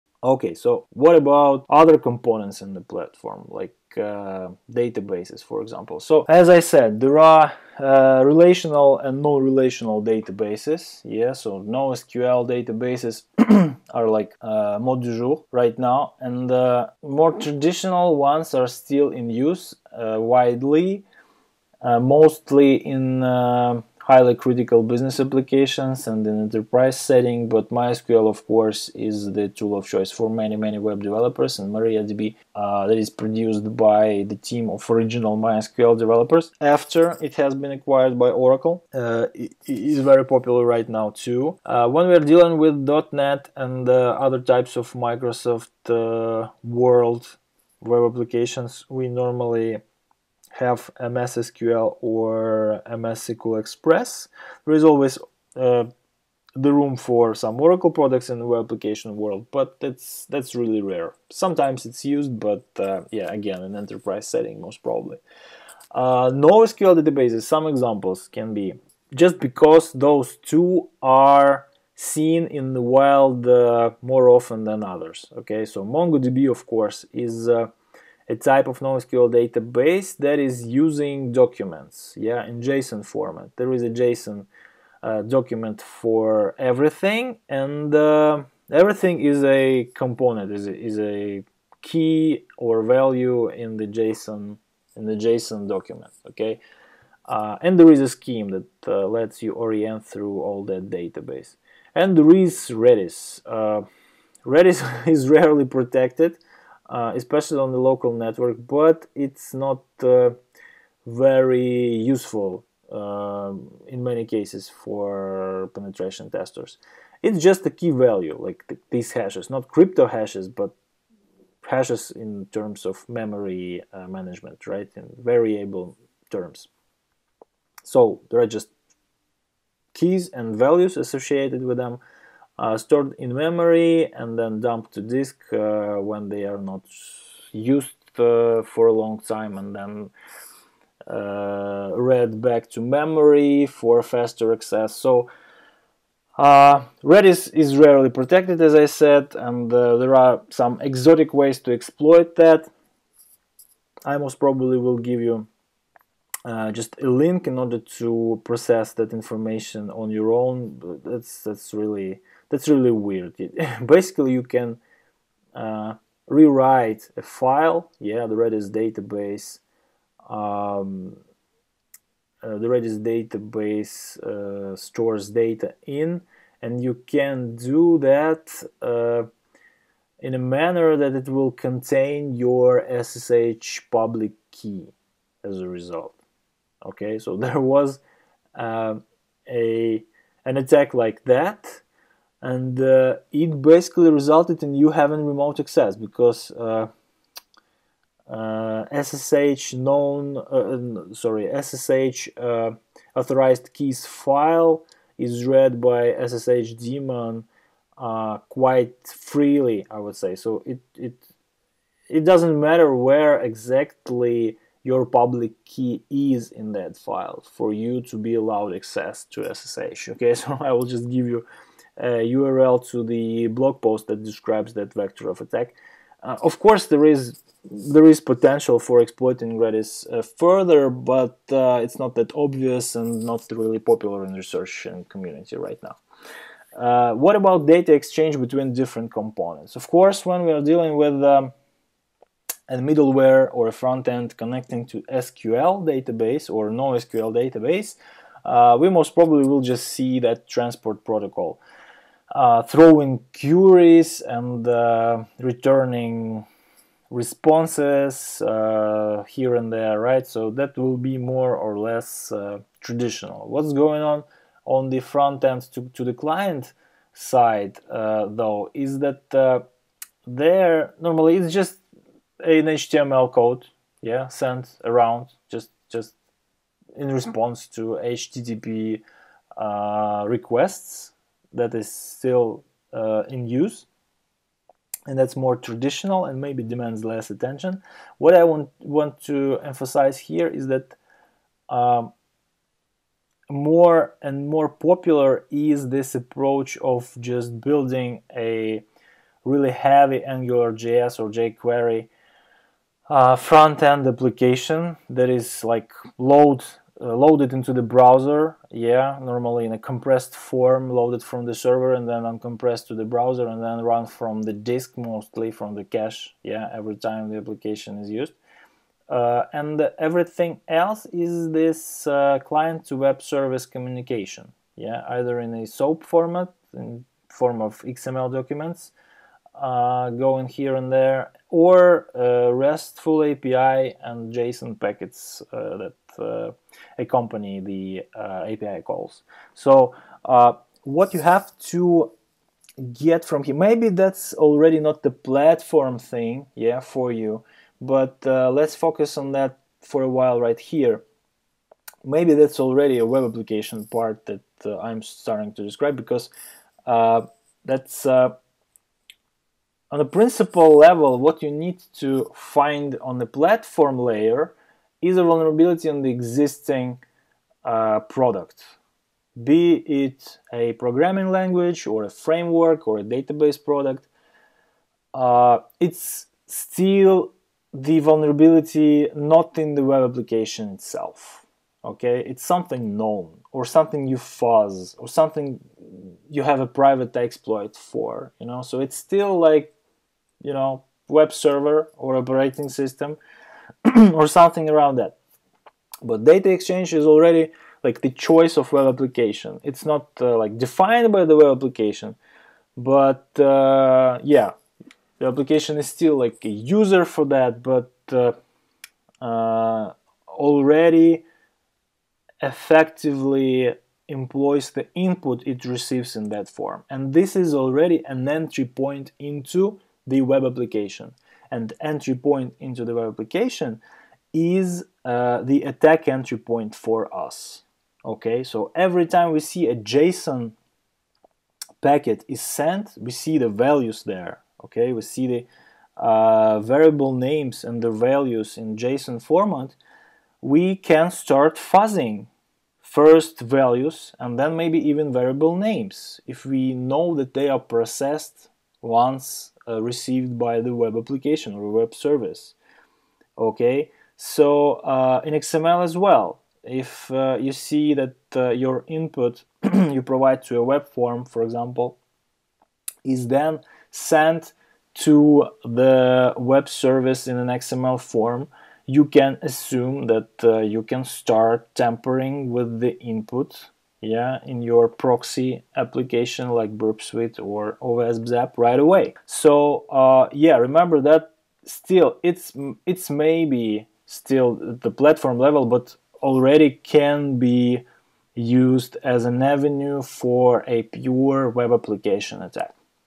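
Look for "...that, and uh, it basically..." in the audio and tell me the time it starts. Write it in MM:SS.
03:11.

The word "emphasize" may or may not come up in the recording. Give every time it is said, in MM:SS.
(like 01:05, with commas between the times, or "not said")
04:49.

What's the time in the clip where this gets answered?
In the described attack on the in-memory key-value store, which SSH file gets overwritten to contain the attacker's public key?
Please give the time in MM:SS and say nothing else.
03:23.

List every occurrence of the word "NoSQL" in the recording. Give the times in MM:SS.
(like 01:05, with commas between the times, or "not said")
00:11, 01:06, 01:18, 04:06.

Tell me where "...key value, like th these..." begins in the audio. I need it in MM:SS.
01:57.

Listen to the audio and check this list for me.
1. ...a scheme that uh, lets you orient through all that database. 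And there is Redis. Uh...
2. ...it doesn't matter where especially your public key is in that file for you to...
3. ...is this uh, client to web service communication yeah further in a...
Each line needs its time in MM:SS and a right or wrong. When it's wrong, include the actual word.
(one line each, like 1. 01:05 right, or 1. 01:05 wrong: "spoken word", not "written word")
1. 01:38 right
2. 03:32 wrong: "exactly", not "especially"
3. 05:21 wrong: "either", not "further".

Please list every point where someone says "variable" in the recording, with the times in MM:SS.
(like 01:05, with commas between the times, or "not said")
02:05, 07:16, 07:25.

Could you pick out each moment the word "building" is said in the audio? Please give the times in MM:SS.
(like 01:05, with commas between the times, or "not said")
04:57.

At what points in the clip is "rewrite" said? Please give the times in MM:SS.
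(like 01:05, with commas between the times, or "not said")
02:46.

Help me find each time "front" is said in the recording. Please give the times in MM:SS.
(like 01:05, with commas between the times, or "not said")
04:03, 04:25, 05:03.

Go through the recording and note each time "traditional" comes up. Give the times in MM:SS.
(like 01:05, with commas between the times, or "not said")
00:17, 04:22, 04:45.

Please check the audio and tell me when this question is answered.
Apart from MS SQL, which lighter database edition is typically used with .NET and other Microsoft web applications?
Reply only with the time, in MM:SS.
00:52.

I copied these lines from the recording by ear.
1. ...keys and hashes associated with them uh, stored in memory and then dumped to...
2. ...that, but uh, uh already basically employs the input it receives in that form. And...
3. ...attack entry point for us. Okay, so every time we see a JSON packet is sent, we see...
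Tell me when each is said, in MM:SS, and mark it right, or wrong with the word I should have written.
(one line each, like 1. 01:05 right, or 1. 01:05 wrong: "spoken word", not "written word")
1. 02:09 wrong: "values", not "hashes"
2. 06:47 wrong: "effectively", not "basically"
3. 07:05 right.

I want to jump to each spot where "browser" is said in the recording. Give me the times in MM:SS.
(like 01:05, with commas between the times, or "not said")
05:07, 05:13.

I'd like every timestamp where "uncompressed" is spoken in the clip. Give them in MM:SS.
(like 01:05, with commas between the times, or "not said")
05:12.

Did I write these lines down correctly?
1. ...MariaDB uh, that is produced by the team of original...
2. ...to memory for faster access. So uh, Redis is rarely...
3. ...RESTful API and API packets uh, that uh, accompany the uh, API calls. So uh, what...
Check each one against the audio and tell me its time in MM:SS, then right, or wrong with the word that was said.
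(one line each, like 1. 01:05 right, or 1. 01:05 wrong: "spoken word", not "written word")
1. 00:31 right
2. 02:22 right
3. 05:32 wrong: "JSON", not "API".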